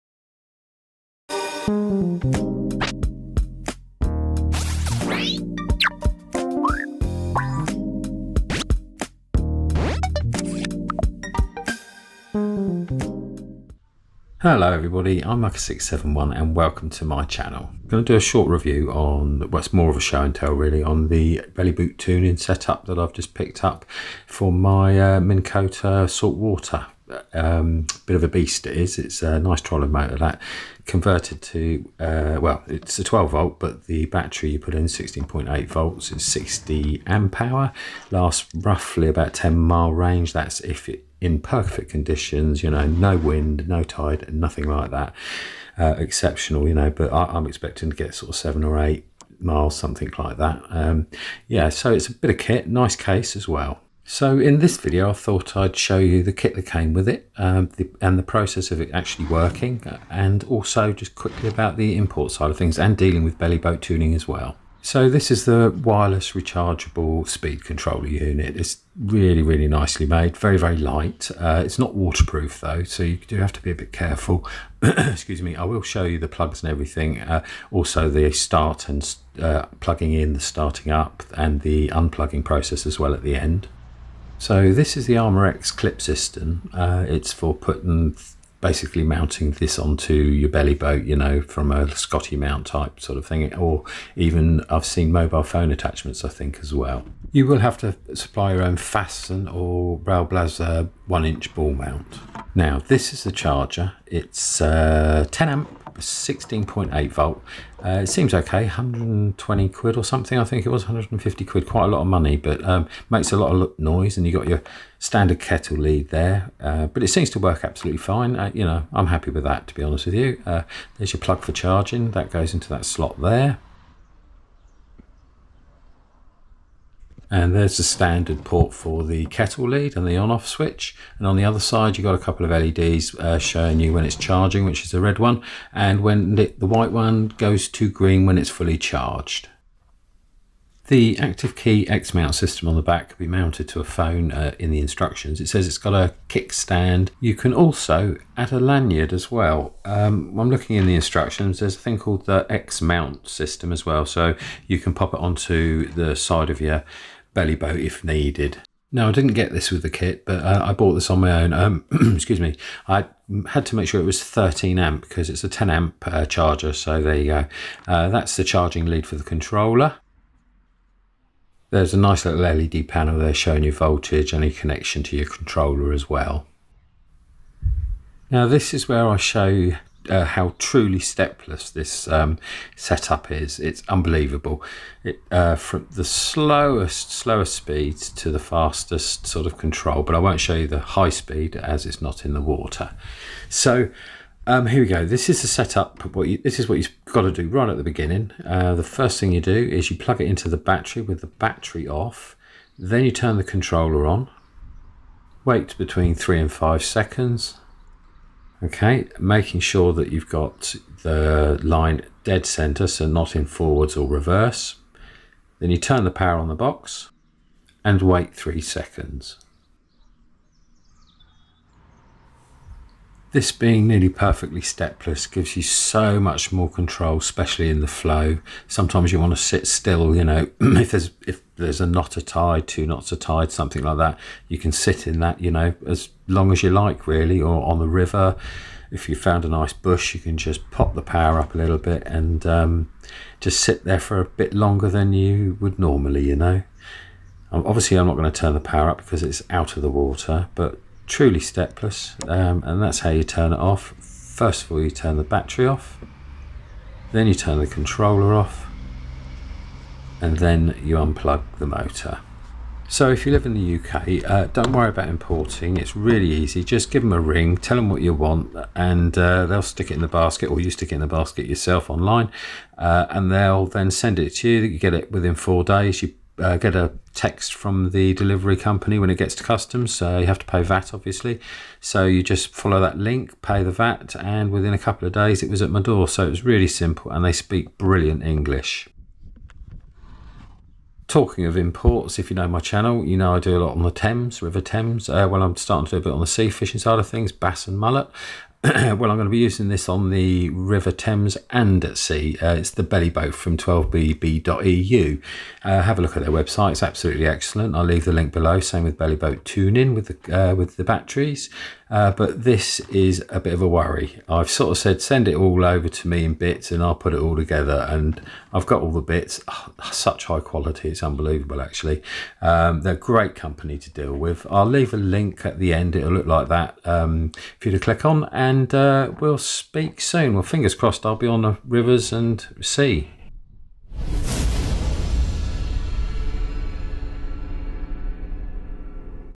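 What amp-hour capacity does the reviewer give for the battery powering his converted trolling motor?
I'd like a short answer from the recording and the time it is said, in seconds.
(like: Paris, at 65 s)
60 amp hour, at 36 s.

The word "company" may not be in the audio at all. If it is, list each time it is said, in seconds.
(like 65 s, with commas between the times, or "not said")
278 s, 323 s.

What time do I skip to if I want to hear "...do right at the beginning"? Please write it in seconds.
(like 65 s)
197 s.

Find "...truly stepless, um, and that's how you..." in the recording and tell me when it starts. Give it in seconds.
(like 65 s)
251 s.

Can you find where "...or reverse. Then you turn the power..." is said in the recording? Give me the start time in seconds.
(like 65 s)
213 s.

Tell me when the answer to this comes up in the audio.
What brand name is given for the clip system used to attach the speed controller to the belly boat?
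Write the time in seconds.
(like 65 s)
85 s.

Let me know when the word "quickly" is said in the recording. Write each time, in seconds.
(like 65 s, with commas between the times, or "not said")
61 s.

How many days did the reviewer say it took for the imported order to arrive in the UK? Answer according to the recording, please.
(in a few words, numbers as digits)
4 days.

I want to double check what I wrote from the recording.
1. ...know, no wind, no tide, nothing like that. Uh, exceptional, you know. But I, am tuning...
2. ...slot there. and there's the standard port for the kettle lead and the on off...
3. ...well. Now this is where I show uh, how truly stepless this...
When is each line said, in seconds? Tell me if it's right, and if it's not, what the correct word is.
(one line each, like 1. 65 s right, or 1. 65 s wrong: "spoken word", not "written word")
1. 42 s wrong: "expecting", not "tuning"
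2. 122 s right
3. 176 s right.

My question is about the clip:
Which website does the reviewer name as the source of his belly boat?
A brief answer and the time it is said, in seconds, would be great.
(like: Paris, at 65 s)
12bb.eu, at 303 s.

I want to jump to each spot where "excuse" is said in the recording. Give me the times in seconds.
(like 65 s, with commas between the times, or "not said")
74 s, 162 s.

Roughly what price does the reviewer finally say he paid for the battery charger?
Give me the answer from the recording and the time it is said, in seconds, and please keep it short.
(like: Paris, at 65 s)
150 quid, at 110 s.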